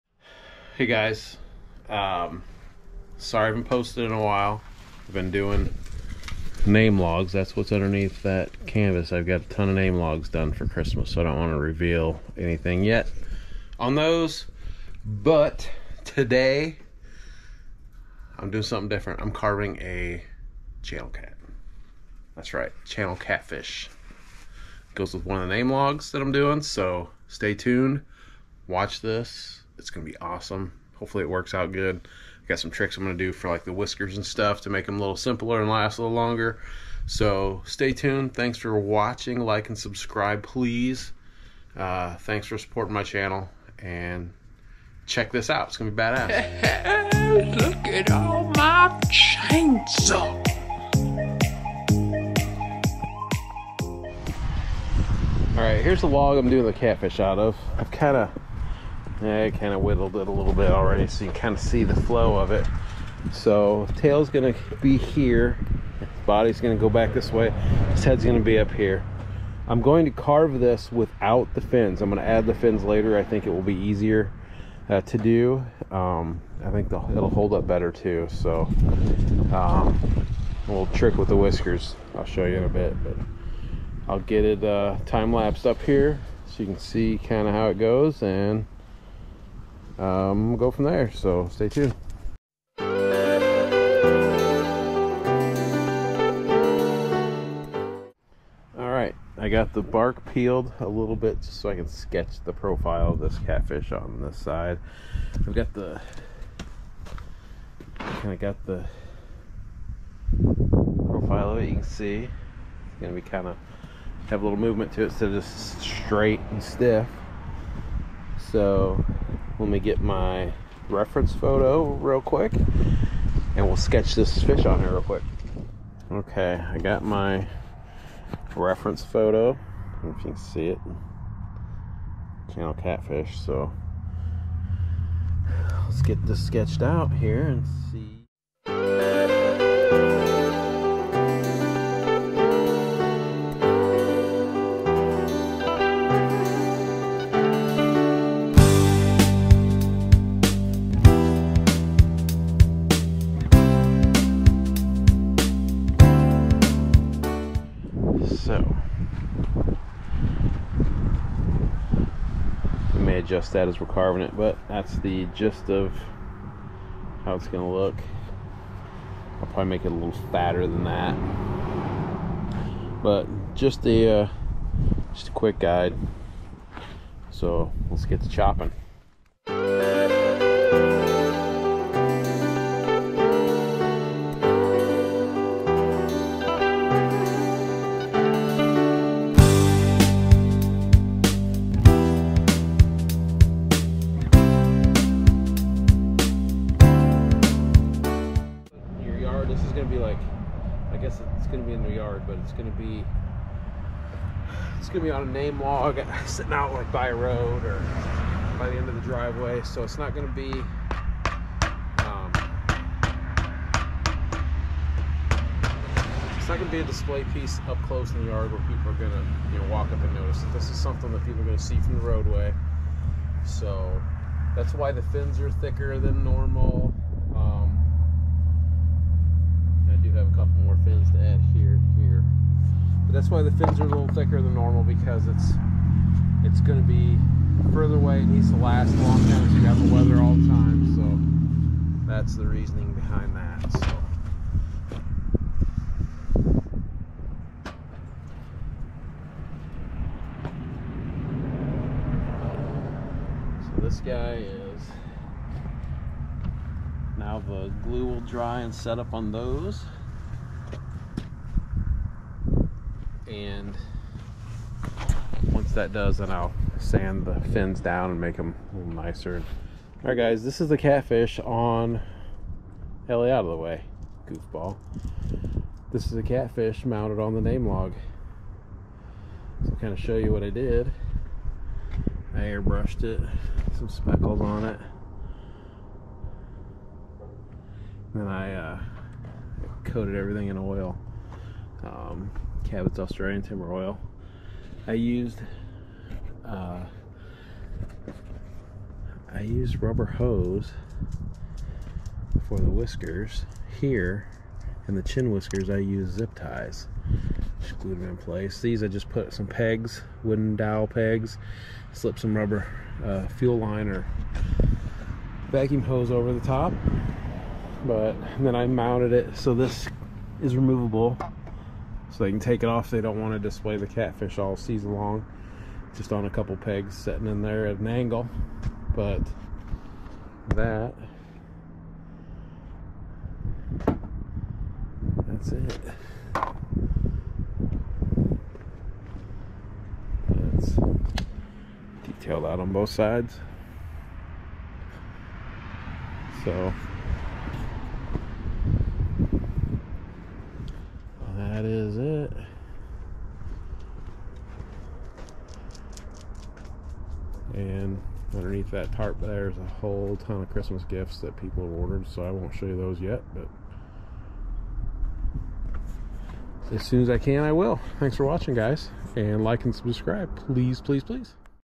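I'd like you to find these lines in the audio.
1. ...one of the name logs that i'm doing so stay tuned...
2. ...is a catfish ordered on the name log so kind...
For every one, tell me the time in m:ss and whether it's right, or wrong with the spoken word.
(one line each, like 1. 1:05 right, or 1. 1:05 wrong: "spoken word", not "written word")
1. 0:25 right
2. 4:36 wrong: "mounted", not "ordered".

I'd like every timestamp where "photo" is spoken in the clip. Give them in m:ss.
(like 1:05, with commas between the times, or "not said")
2:01, 2:09.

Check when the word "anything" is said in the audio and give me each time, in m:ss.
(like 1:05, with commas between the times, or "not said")
0:12.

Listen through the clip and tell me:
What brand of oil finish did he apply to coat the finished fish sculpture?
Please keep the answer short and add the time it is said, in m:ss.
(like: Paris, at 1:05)
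Cabot's Australian Timber Oil, at 4:52.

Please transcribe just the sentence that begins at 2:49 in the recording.
I'll probably make it a little fatter than that.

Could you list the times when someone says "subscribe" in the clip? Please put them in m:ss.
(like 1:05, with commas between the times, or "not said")
0:39, 6:09.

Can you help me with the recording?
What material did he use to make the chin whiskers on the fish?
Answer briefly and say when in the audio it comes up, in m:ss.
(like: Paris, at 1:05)
Zip ties, at 5:06.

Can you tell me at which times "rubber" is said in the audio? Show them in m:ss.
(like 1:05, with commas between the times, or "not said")
4:59, 5:12.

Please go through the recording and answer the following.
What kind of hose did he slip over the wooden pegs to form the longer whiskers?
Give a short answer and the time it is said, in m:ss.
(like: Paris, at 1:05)
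Fuel line or vacuum hose, at 5:13.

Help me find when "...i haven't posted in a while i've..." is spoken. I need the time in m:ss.
0:03.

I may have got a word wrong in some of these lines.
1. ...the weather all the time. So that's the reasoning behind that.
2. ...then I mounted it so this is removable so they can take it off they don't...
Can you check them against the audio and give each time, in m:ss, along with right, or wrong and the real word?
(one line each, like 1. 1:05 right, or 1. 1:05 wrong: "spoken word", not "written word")
1. 3:59 right
2. 5:18 right.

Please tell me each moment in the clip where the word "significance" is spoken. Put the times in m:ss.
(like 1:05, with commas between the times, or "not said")
not said.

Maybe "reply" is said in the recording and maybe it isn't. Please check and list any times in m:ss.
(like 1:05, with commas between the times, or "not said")
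not said.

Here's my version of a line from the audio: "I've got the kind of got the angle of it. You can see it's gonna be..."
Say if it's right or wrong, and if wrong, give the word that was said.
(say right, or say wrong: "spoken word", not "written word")
wrong: "profile", not "angle".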